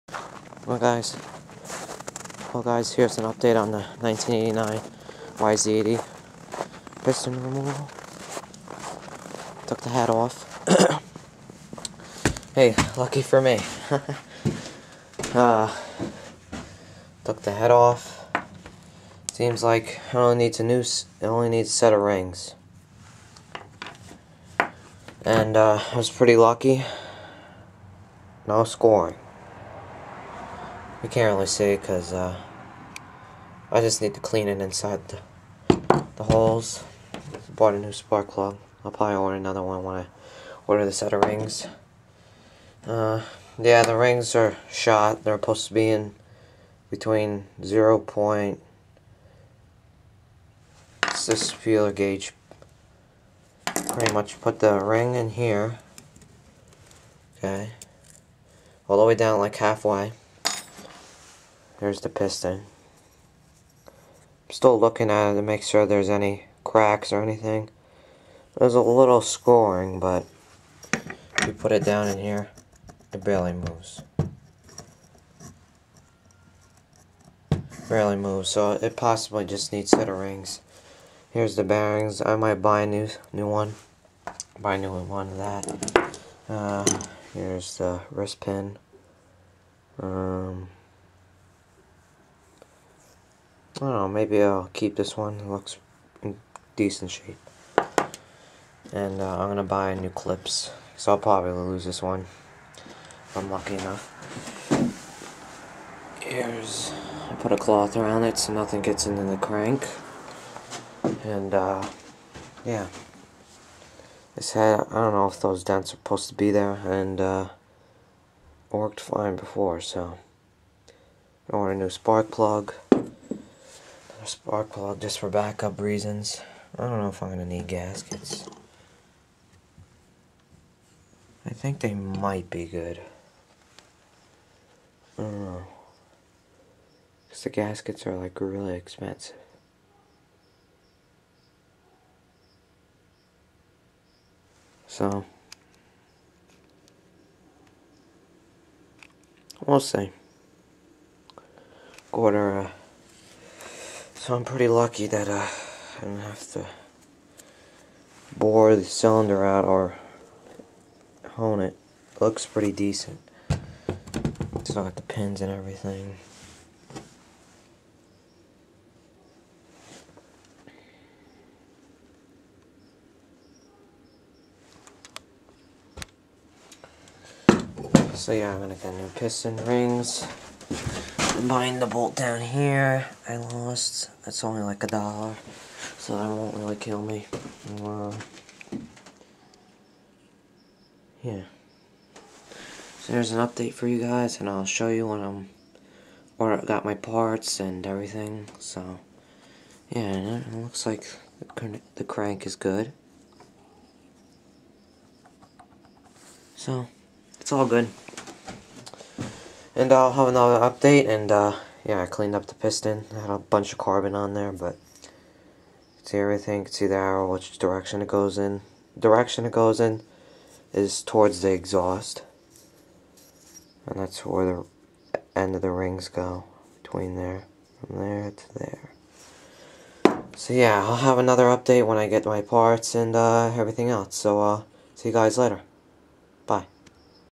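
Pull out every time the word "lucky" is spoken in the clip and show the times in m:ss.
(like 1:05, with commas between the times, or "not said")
0:12, 0:26, 1:43, 2:34.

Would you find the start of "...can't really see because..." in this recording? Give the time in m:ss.
0:31.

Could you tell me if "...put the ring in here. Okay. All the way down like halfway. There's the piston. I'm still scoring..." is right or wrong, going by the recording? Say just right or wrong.
wrong.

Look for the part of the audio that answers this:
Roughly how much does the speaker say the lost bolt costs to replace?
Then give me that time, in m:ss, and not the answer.
3:04.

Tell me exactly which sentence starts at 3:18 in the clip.
So yeah, it looks like the crank is good.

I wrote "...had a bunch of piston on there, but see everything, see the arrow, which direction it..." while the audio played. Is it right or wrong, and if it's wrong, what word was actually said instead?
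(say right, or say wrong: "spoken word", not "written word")
wrong: "carbon", not "piston".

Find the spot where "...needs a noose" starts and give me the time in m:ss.
0:20.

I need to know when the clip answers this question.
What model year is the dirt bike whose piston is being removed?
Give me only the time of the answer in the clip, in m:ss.
0:03.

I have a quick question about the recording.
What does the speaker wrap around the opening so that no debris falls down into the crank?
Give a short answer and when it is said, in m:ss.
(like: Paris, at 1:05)
a cloth, at 1:47.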